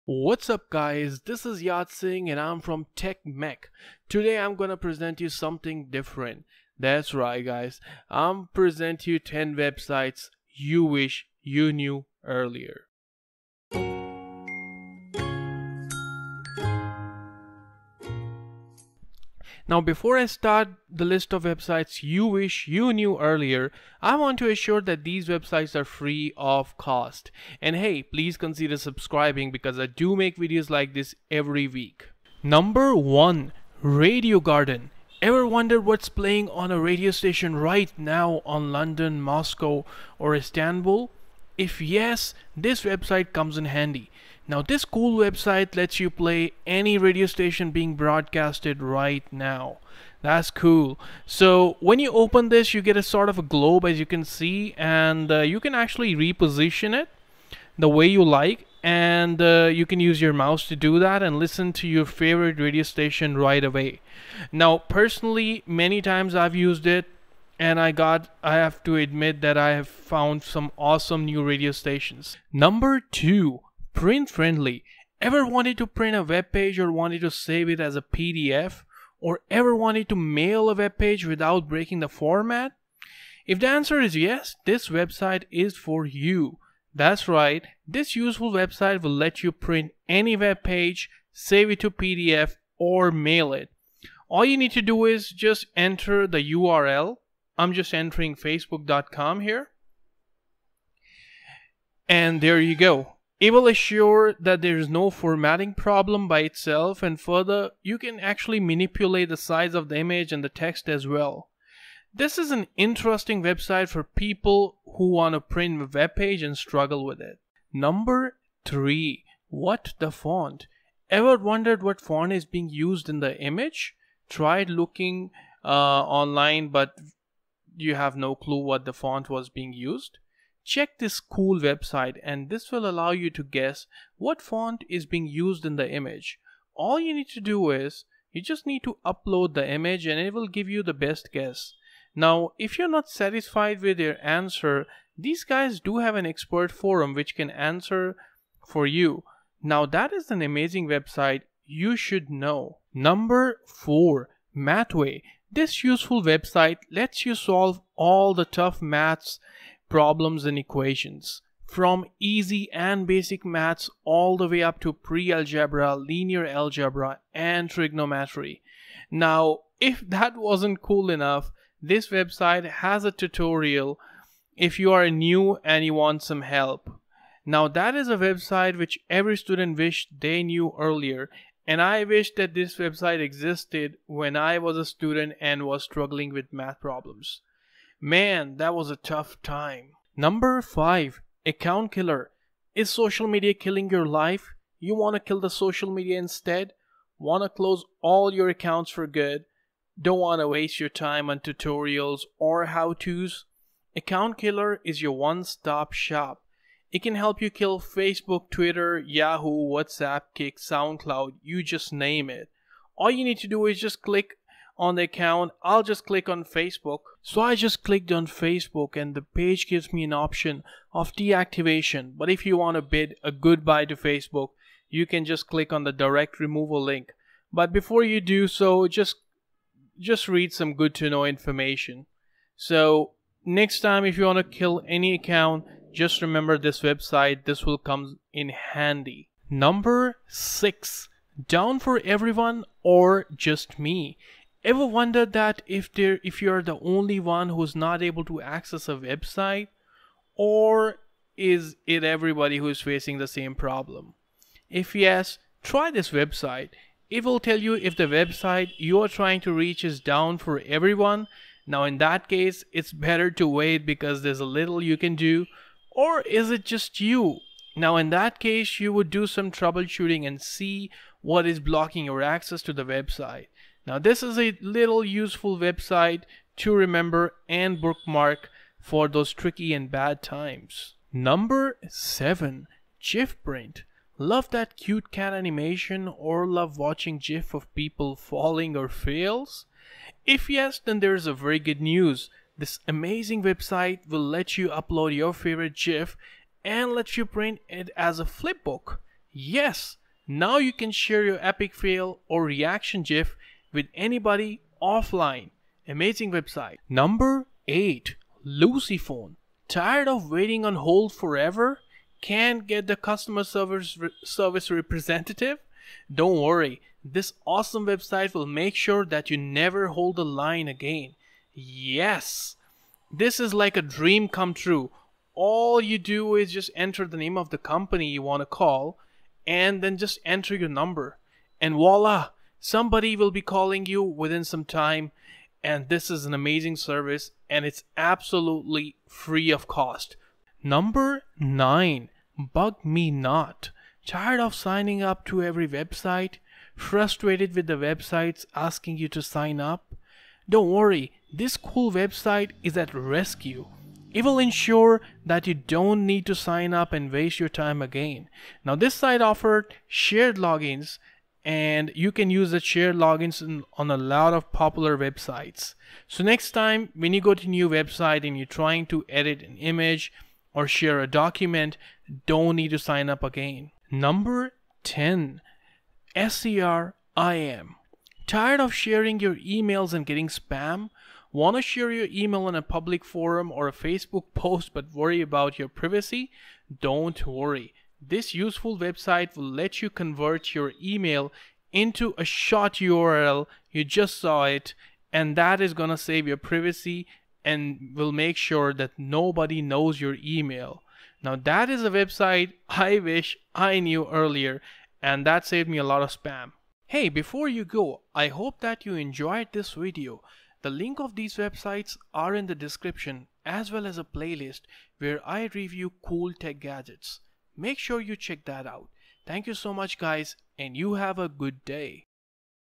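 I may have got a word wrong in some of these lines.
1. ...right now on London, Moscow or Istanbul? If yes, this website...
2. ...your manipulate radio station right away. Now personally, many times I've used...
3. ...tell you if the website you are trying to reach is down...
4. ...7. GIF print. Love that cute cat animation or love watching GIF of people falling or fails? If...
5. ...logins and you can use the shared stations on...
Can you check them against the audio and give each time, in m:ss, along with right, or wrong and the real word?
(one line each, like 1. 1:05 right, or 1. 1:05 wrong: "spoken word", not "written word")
1. 0:37 right
2. 1:01 wrong: "favorite", not "manipulate"
3. 4:17 right
4. 4:41 right
5. 6:00 wrong: "logins", not "stations".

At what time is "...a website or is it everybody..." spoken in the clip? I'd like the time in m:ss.
4:08.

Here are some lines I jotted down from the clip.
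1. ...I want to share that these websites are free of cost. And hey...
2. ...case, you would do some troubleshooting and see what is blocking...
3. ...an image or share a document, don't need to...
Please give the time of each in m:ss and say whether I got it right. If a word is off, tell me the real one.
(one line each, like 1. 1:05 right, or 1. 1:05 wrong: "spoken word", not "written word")
1. 0:24 wrong: "assure", not "share"
2. 4:28 right
3. 6:09 right.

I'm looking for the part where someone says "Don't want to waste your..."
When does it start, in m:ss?
3:20.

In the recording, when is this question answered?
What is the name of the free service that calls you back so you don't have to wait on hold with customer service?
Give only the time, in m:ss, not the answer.
5:08.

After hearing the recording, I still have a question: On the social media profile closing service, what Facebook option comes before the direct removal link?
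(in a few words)
Deactivation.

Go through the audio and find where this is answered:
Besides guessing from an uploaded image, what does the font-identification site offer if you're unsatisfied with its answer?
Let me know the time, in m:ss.
2:26.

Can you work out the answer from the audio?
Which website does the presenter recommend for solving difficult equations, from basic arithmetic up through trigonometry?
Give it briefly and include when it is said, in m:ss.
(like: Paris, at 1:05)
Mathway, at 2:34.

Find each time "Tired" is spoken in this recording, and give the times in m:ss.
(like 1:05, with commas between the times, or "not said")
5:09, 5:44, 6:18.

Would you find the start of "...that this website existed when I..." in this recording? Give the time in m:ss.
3:02.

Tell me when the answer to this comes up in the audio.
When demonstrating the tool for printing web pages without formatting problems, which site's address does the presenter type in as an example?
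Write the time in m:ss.
1:38.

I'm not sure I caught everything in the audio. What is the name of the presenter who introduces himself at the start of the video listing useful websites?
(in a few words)
Yad Singh.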